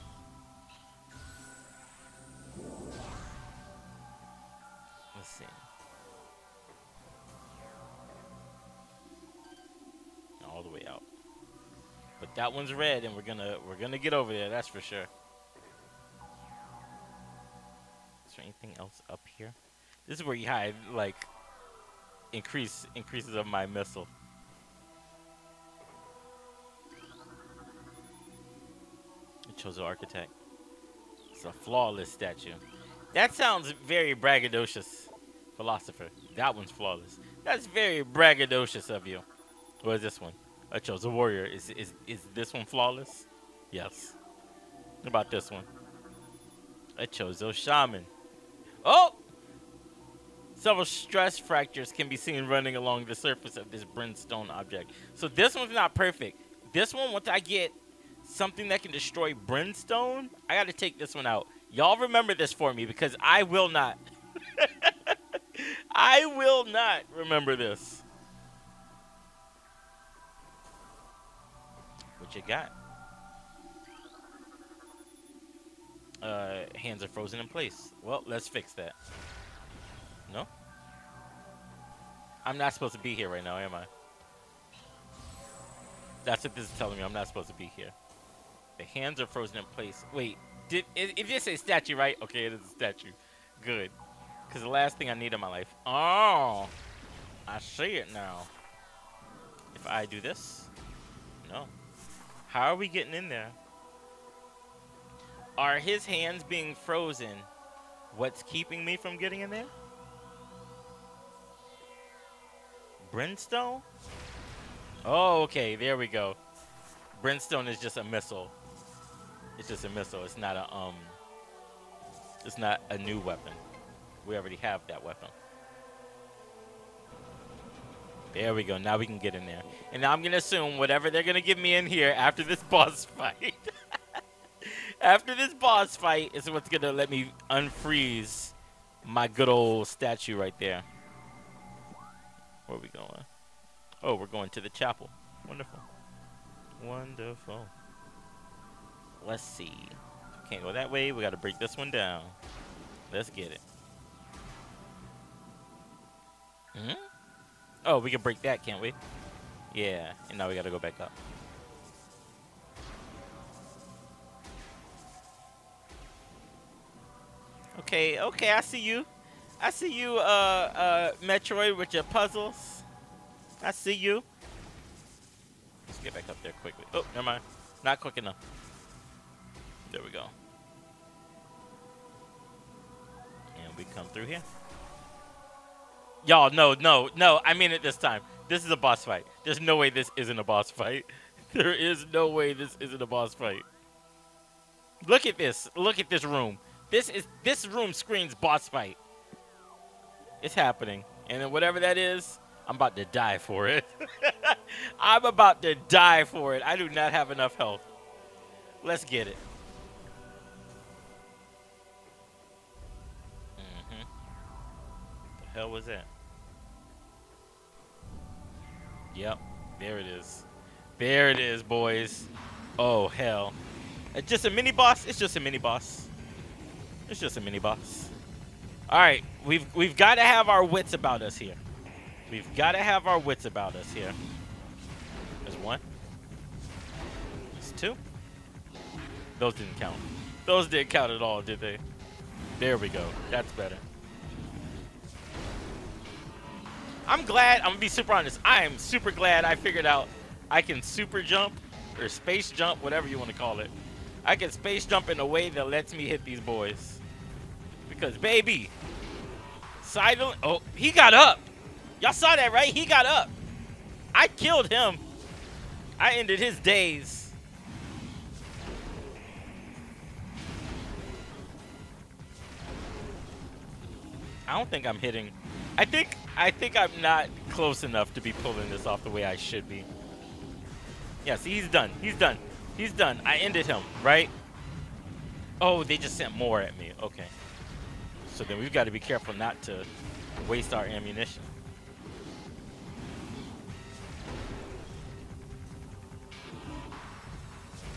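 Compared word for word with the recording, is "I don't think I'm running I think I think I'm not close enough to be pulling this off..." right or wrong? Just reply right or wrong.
wrong.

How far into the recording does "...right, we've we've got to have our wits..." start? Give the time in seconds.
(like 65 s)
228 s.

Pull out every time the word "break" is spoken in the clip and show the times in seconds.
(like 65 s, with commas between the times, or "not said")
151 s, 158 s.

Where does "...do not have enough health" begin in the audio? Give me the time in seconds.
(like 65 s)
206 s.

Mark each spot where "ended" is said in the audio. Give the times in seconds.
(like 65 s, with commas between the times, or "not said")
266 s, 283 s.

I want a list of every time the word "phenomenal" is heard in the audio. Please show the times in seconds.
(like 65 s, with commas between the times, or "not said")
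not said.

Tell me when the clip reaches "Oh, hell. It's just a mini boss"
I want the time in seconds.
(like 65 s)
222 s.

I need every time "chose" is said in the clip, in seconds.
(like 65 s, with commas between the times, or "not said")
29 s.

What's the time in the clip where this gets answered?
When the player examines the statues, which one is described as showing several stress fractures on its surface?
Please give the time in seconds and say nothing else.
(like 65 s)
46 s.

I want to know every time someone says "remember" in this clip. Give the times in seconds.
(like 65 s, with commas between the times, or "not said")
61 s, 67 s.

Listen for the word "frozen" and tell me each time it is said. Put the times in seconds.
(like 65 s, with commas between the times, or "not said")
77 s, 89 s, 106 s.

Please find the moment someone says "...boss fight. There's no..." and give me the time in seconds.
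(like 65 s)
188 s.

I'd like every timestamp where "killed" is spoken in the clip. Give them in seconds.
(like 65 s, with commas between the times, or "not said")
264 s.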